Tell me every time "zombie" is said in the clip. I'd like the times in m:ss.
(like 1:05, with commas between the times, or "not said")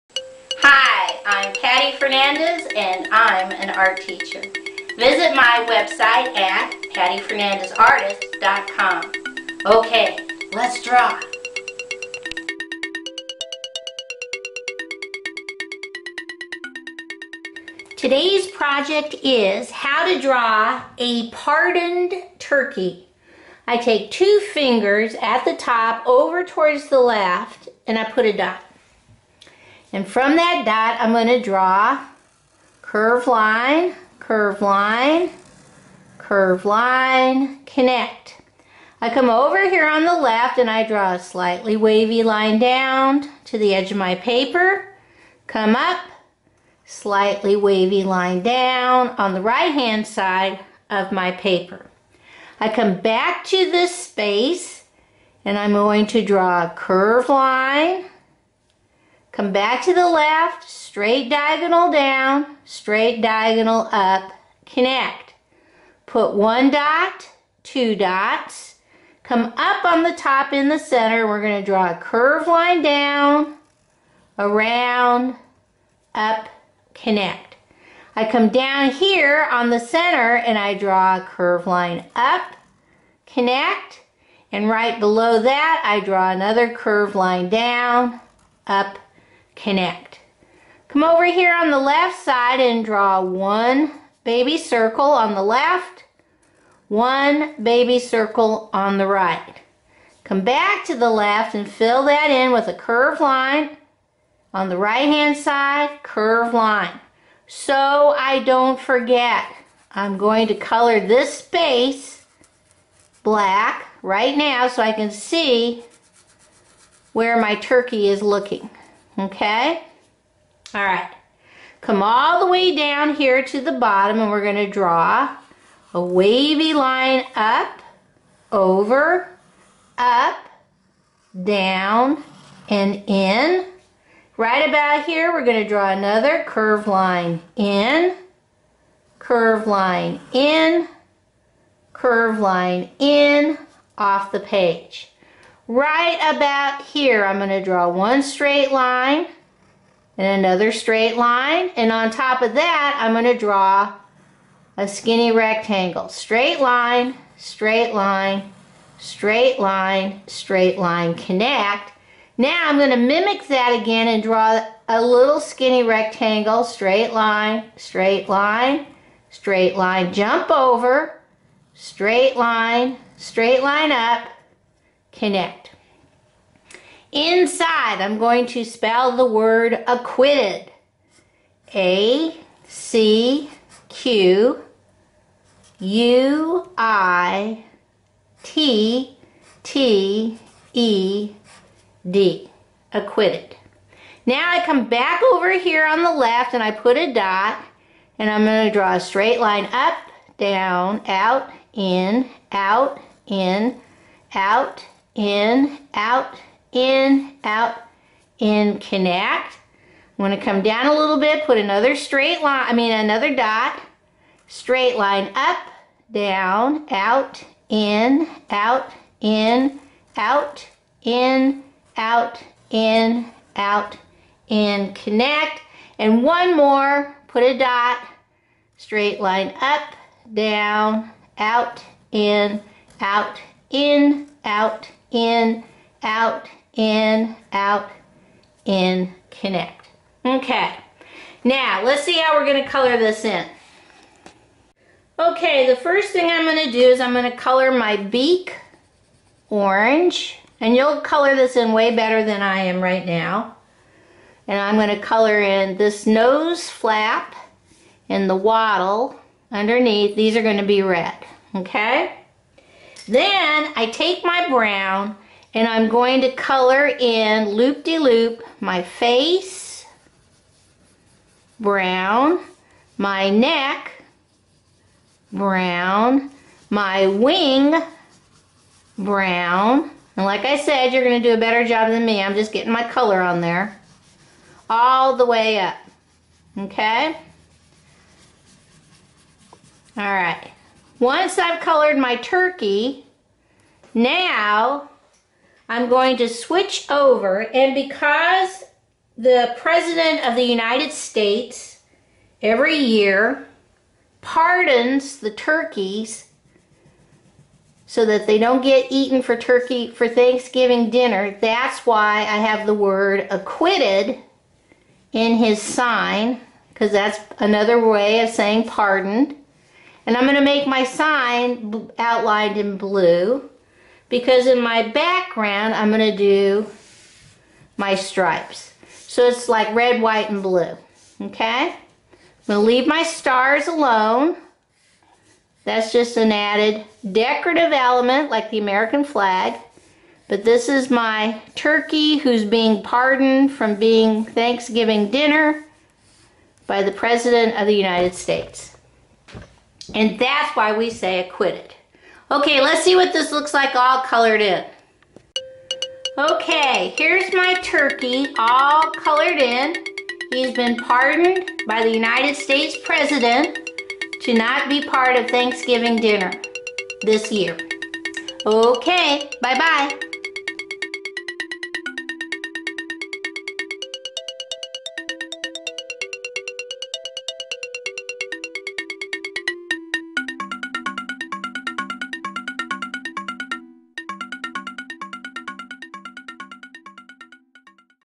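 not said.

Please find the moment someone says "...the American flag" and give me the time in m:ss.
5:38.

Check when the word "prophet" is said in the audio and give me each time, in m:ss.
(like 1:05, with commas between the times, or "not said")
not said.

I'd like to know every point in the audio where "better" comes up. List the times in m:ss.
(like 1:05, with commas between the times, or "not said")
4:11, 4:41.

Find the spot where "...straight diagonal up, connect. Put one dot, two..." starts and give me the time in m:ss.
1:02.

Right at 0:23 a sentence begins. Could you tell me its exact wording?
I take two fingers at the top over towards the left and I put a dot.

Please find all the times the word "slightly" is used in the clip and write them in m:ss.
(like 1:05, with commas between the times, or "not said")
0:41, 0:46.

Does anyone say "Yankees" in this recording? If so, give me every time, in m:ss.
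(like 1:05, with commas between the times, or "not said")
not said.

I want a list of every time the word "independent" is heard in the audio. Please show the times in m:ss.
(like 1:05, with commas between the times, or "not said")
not said.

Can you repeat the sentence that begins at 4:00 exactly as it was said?
Okay, now let's see how we're gonna color this in.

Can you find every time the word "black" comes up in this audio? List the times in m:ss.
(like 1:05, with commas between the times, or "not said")
1:53.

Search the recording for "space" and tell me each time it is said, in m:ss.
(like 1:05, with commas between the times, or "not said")
0:53, 1:51.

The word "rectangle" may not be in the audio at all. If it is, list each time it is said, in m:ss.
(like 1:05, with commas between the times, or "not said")
2:35, 2:45.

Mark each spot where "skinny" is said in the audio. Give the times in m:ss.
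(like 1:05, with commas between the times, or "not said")
2:34, 2:45.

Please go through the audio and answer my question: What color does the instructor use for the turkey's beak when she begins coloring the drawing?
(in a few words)
Orange.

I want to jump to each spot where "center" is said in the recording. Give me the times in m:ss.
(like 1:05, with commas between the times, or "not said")
1:10, 1:19.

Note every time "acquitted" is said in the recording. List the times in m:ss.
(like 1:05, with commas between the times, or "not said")
2:59, 3:12, 5:13, 5:51.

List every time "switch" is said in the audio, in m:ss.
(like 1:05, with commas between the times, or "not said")
4:56.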